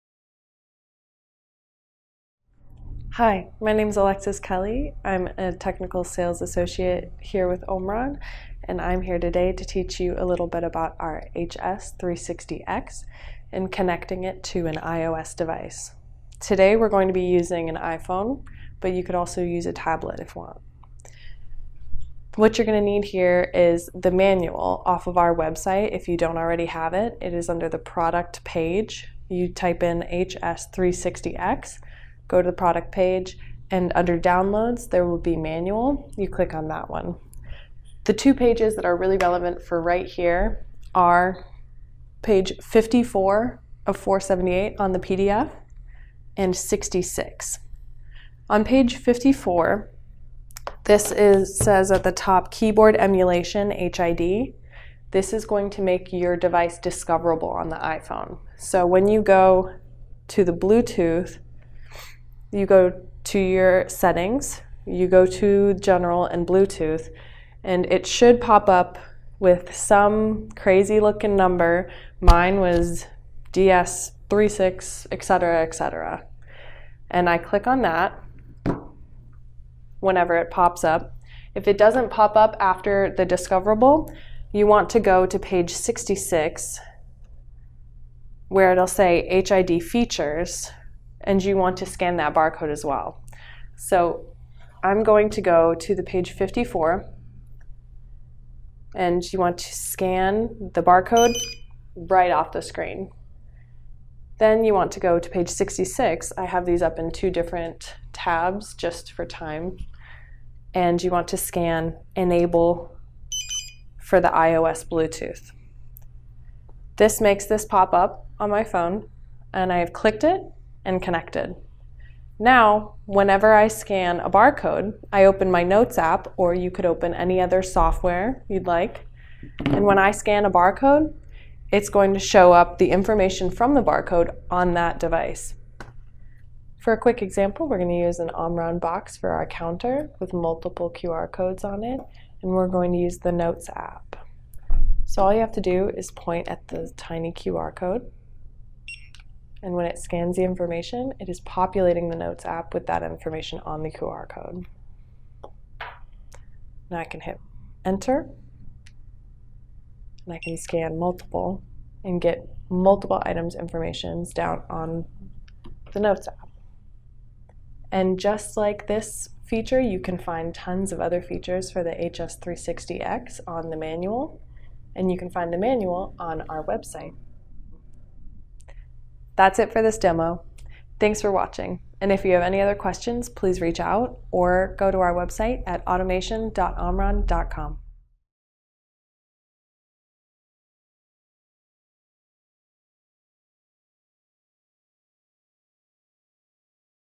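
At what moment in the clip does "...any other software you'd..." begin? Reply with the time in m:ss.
2:07.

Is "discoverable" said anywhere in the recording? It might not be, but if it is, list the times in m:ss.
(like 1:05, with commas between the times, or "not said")
0:56, 1:23.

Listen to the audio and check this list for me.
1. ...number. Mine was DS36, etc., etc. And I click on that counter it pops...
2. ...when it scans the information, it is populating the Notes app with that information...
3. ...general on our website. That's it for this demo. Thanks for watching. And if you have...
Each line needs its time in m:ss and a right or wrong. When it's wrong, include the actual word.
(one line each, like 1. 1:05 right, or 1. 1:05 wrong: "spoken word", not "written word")
1. 1:11 wrong: "whenever", not "counter"
2. 2:29 right
3. 2:55 wrong: "manual", not "general".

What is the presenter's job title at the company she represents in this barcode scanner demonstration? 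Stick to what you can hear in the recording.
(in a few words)
Technical sales associate.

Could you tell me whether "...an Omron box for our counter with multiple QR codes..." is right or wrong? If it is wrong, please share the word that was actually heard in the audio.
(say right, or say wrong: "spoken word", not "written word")
right.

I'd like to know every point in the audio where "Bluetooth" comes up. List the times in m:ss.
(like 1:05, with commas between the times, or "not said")
1:00, 1:06, 1:54.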